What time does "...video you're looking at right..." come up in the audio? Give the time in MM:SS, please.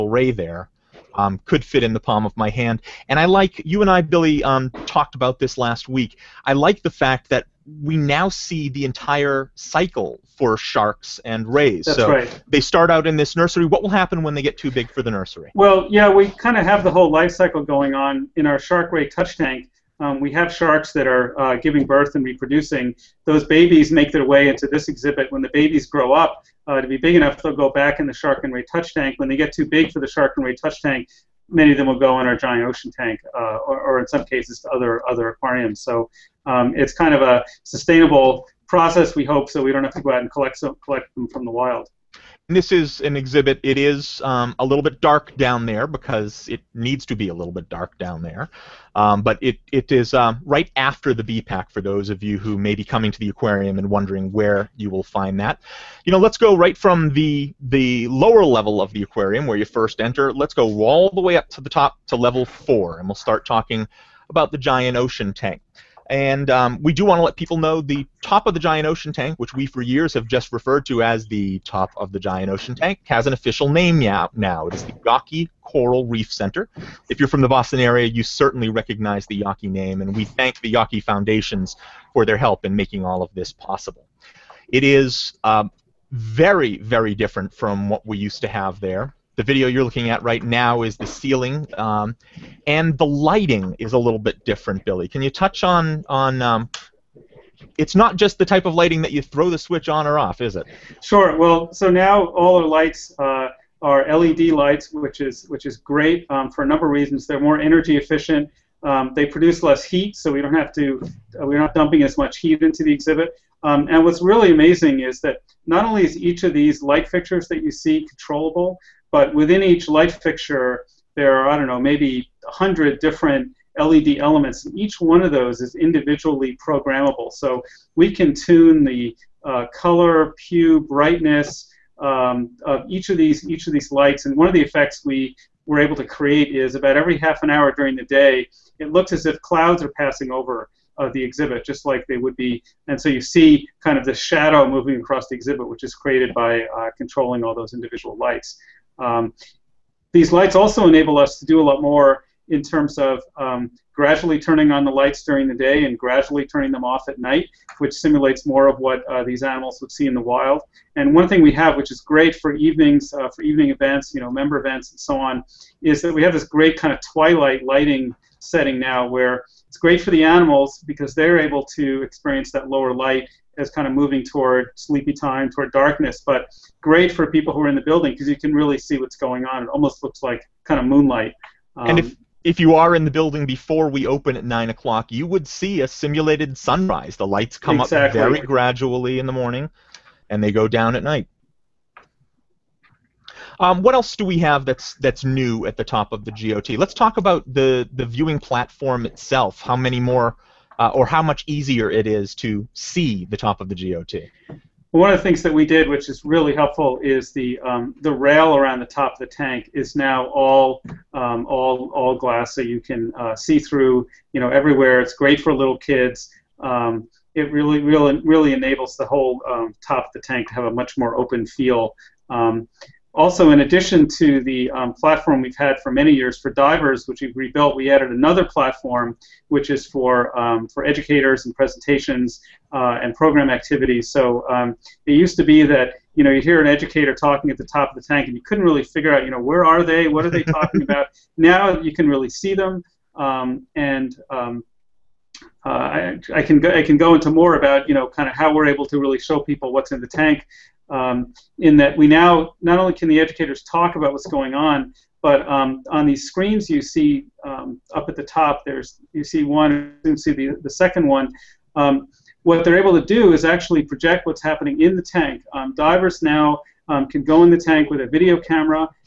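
01:29.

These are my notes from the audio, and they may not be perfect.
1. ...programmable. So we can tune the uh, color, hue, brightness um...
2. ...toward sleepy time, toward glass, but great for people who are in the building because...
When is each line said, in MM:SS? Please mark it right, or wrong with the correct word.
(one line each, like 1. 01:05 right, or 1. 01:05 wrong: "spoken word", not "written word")
1. 02:06 right
2. 02:54 wrong: "darkness", not "glass".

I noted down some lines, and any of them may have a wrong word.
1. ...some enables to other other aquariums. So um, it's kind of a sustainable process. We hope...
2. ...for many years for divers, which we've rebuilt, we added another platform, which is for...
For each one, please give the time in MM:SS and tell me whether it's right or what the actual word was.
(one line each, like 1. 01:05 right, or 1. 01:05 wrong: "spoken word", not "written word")
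1. 00:34 wrong: "cases", not "enables"
2. 03:45 right.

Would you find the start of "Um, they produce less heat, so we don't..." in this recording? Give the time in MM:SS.
01:48.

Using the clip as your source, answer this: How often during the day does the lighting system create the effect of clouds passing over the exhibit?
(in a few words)
every half an hour.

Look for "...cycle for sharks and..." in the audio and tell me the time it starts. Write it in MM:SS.
00:09.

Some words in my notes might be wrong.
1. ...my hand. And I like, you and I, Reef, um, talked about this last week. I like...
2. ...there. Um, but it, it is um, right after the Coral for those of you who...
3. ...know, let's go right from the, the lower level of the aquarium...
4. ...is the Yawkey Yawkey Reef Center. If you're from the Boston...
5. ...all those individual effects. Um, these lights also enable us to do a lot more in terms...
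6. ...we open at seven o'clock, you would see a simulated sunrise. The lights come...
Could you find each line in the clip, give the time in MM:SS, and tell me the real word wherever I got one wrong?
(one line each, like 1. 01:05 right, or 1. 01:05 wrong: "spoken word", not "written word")
1. 00:02 wrong: "Billy", not "Reef"
2. 00:48 wrong: "BPAC", not "Coral"
3. 00:56 right
4. 01:14 wrong: "Coral", not "Yawkey"
5. 02:27 wrong: "lights", not "effects"
6. 03:03 wrong: "nine", not "seven".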